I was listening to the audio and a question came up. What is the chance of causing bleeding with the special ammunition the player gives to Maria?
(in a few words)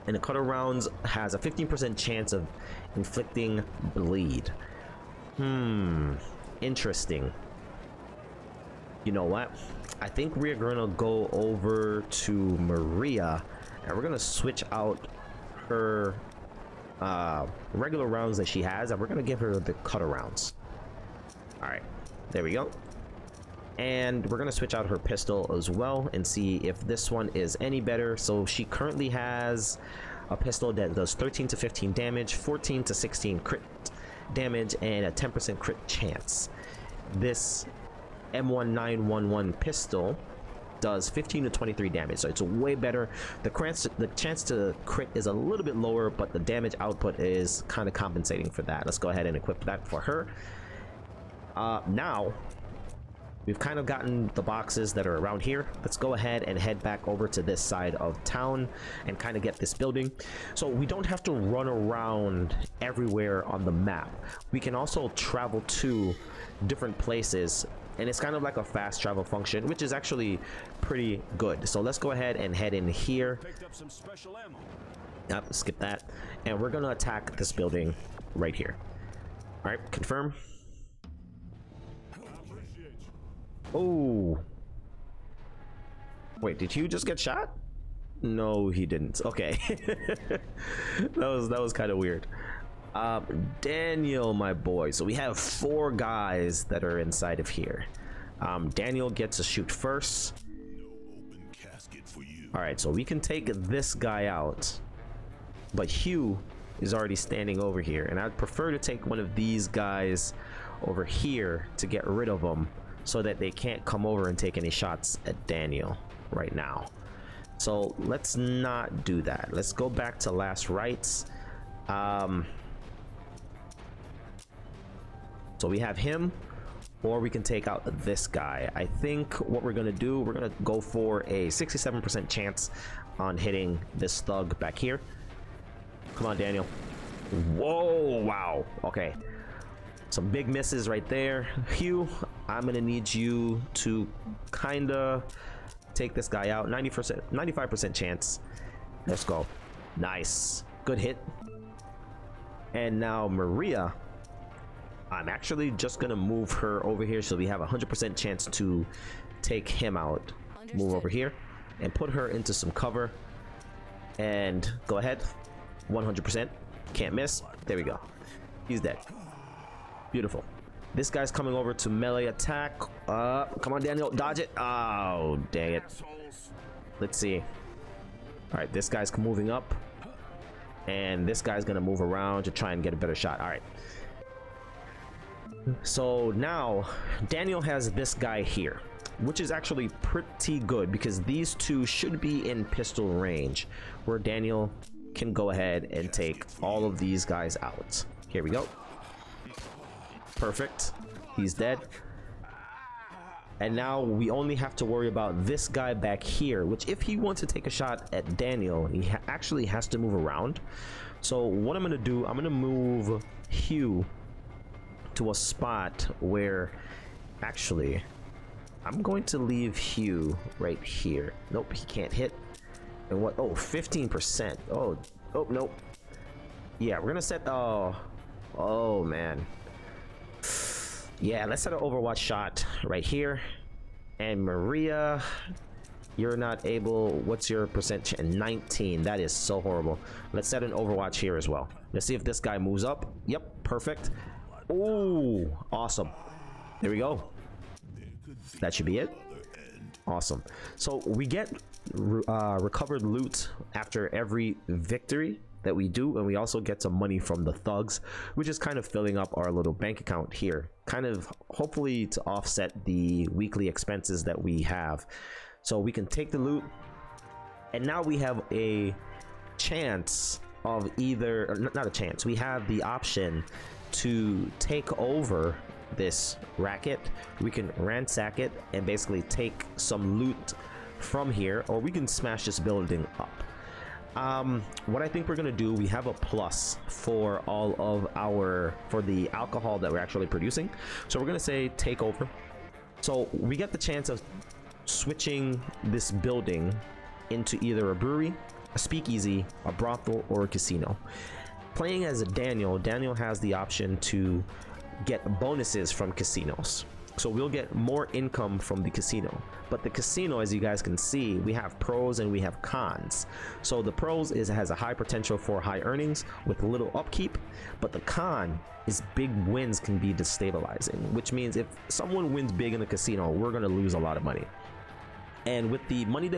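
15%.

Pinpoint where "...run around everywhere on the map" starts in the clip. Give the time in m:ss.
1:01.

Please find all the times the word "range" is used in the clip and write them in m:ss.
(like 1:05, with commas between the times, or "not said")
3:13.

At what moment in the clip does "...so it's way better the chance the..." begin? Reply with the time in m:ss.
0:42.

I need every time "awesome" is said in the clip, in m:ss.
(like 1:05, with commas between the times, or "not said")
4:05, 4:10.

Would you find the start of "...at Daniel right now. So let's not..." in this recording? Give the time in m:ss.
1:55.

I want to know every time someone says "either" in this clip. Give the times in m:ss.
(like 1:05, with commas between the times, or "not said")
4:30, 4:57.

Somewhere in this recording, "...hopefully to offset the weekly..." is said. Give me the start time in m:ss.
4:21.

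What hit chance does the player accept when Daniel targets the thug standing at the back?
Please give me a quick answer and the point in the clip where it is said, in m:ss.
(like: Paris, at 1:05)
67%, at 2:11.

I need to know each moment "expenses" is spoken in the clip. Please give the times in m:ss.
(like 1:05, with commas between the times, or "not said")
4:23.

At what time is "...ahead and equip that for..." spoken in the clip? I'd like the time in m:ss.
0:49.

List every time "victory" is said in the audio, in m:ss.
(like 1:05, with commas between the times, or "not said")
4:14.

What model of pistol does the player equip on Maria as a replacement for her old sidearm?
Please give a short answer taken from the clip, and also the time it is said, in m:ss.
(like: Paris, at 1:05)
M1911, at 0:38.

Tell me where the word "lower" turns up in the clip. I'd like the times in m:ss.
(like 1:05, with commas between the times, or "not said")
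0:45.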